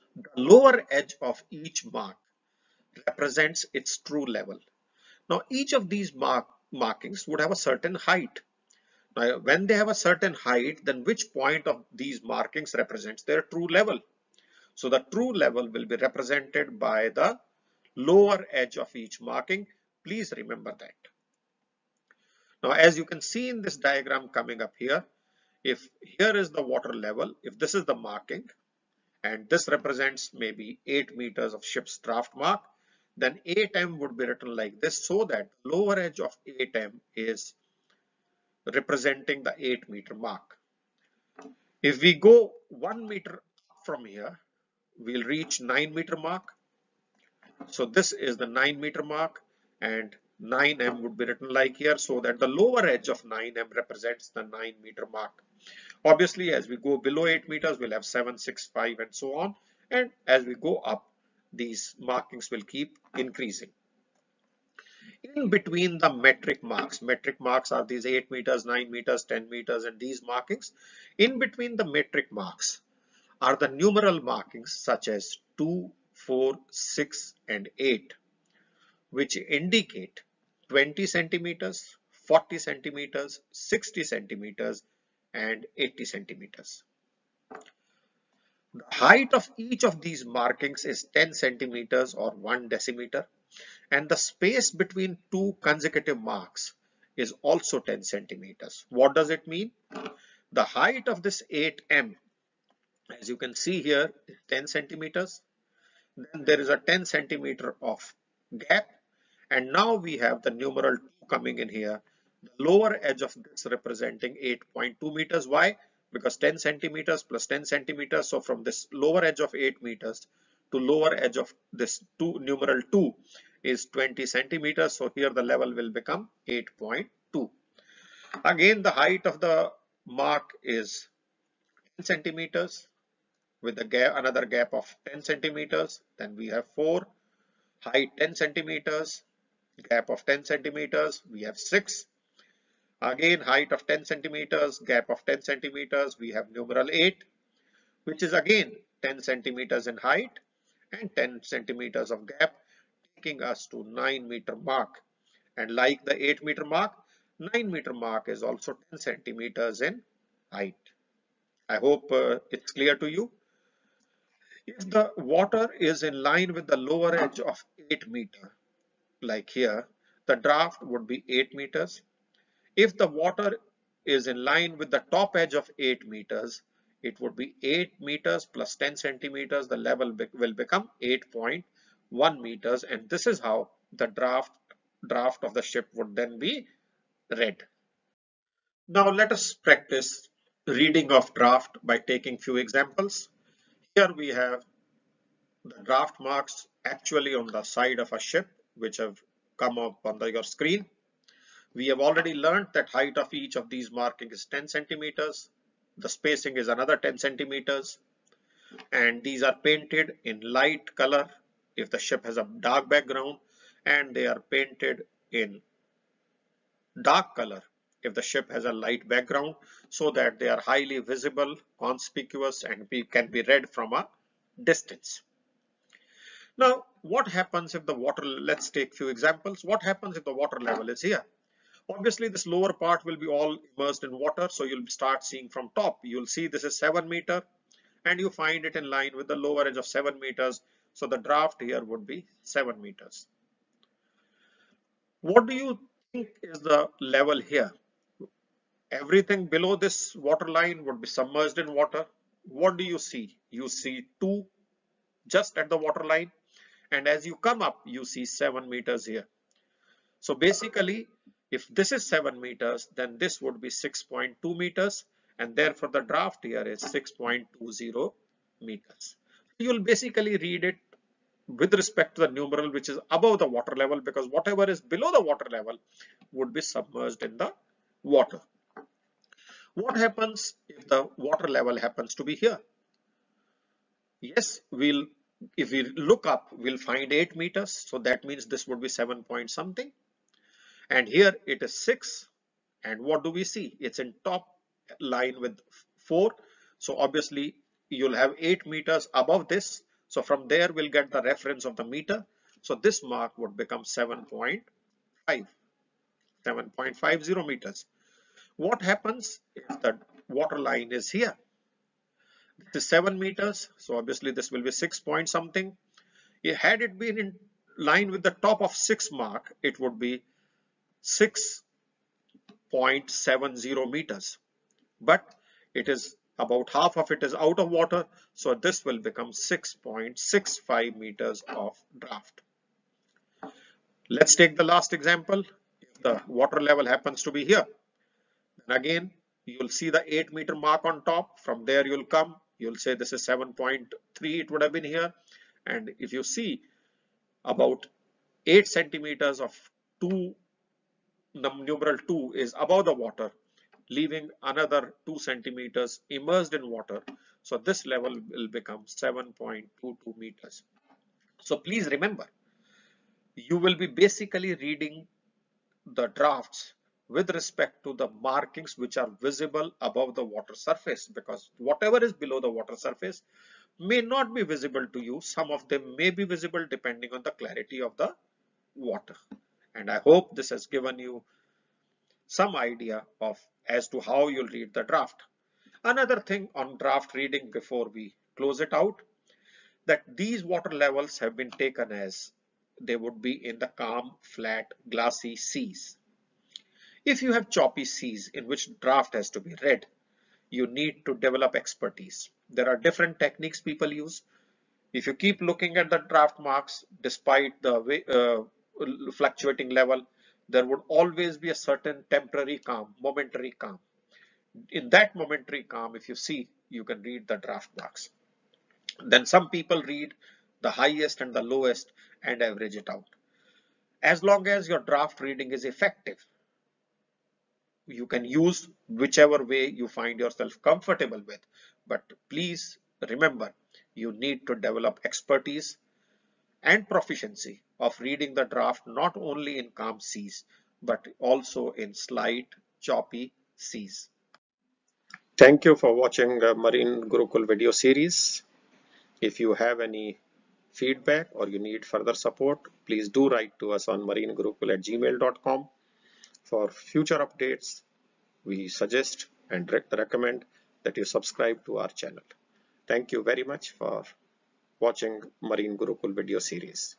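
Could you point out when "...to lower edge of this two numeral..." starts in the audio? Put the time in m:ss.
2:00.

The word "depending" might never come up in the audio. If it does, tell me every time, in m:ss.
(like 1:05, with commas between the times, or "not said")
6:16.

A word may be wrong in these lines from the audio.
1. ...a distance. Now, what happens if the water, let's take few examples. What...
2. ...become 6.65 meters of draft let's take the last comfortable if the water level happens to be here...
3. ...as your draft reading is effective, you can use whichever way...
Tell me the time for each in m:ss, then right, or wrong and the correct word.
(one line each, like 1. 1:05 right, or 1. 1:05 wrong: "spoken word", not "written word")
1. 3:43 right
2. 5:28 wrong: "example", not "comfortable"
3. 7:04 right.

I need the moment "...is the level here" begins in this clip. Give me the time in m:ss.
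4:06.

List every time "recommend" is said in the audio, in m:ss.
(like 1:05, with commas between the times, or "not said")
7:39.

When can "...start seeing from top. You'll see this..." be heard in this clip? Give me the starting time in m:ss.
3:54.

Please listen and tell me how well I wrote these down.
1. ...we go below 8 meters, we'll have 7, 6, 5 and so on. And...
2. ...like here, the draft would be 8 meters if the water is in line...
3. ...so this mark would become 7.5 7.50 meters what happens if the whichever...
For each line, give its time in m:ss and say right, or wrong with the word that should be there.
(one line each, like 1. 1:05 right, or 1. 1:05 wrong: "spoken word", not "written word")
1. 0:56 right
2. 2:49 right
3. 5:02 wrong: "water", not "whichever".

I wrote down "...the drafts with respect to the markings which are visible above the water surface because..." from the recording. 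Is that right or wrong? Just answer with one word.
right.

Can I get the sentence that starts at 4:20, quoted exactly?
So basically if this is 7 meters, then this would be 6.2 meters and therefore the draft here is 6.20 meters.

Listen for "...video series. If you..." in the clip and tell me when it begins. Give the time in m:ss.
7:27.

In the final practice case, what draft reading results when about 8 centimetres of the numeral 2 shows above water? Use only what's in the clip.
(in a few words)
7.22 meters.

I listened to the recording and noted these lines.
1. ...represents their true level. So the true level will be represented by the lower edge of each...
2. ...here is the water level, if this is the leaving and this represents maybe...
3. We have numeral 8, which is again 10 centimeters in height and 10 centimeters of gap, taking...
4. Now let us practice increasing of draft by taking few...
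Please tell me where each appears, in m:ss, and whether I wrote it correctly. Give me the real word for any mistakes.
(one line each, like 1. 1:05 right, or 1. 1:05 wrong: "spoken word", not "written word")
1. 0:12 right
2. 0:26 wrong: "marking", not "leaving"
3. 2:26 right
4. 3:08 wrong: "reading", not "increasing".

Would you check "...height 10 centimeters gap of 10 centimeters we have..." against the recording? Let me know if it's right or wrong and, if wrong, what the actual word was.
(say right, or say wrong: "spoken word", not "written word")
right.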